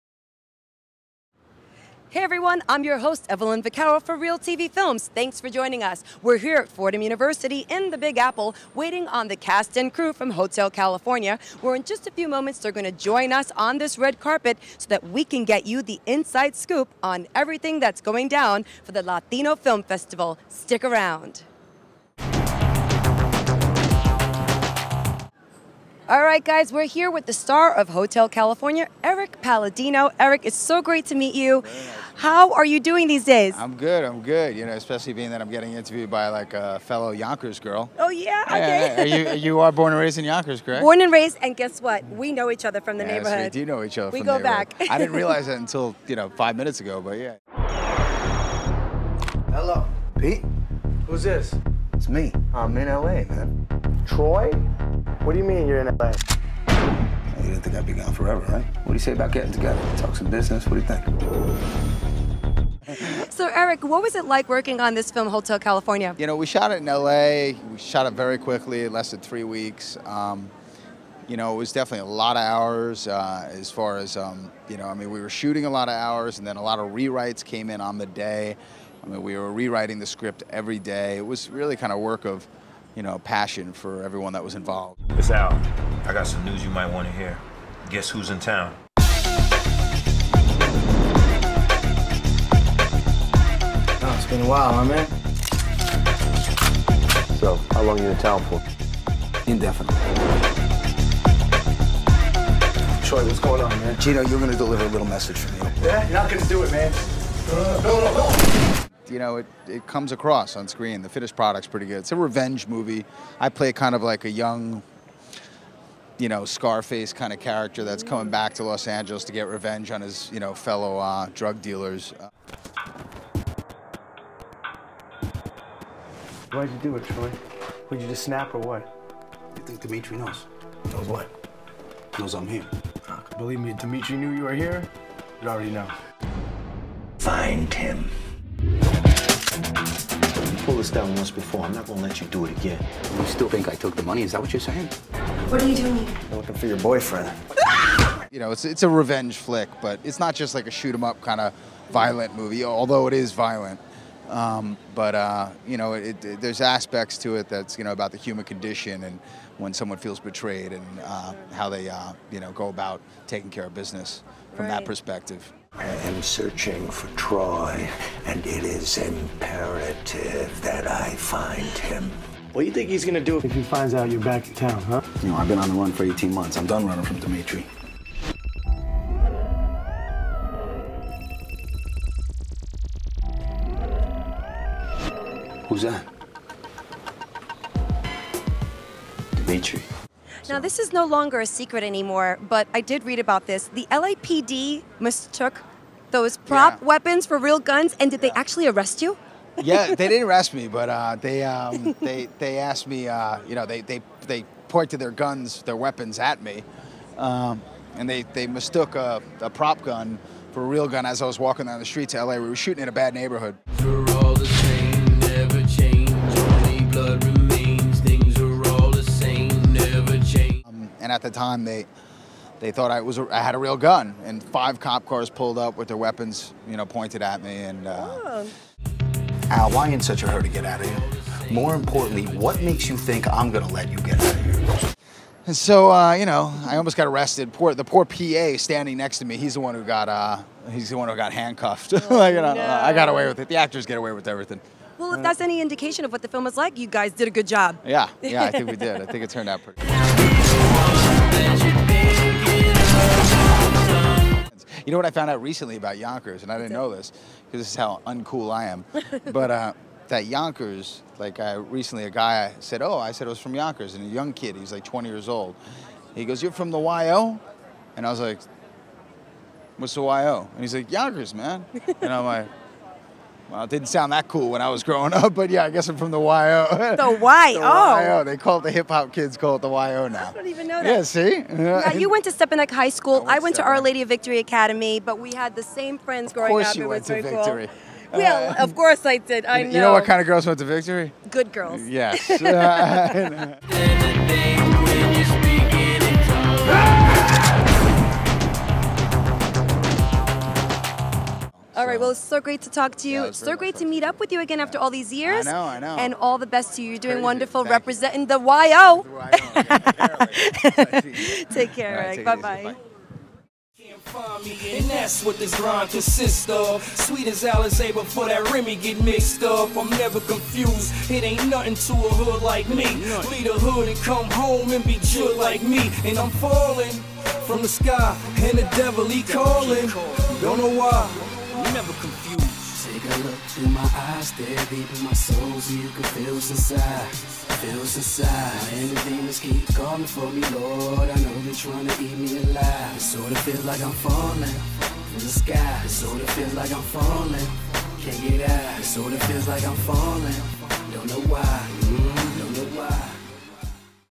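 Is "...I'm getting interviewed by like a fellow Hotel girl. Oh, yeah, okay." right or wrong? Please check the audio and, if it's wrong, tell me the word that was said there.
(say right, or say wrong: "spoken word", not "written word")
wrong: "Yonkers", not "Hotel".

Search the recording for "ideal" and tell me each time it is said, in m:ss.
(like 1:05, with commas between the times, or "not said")
not said.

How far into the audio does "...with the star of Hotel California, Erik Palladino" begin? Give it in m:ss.
0:27.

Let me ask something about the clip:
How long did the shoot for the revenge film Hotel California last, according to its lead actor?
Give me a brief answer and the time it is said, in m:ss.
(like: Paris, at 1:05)
3 weeks, at 1:09.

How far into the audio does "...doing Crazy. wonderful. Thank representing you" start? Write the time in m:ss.
5:06.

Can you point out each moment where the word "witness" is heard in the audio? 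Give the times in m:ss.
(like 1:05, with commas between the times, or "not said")
not said.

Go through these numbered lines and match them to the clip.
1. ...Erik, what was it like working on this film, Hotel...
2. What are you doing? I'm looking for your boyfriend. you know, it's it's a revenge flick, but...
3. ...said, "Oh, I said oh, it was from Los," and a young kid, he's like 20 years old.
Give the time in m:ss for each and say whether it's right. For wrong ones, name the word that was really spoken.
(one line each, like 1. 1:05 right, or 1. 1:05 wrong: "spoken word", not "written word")
1. 1:03 right
2. 2:25 right
3. 4:22 wrong: "Yonkers", not "Los".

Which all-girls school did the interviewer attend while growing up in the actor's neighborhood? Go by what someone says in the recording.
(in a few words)
Our Lady of Victory Academy.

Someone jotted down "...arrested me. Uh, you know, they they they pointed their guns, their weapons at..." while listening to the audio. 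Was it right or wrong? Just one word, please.
wrong.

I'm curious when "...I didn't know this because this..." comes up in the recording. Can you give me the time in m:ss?
4:16.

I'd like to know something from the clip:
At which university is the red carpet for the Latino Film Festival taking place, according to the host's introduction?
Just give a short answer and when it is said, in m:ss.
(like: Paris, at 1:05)
Fordham University, at 0:06.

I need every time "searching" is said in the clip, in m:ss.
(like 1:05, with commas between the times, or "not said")
2:46.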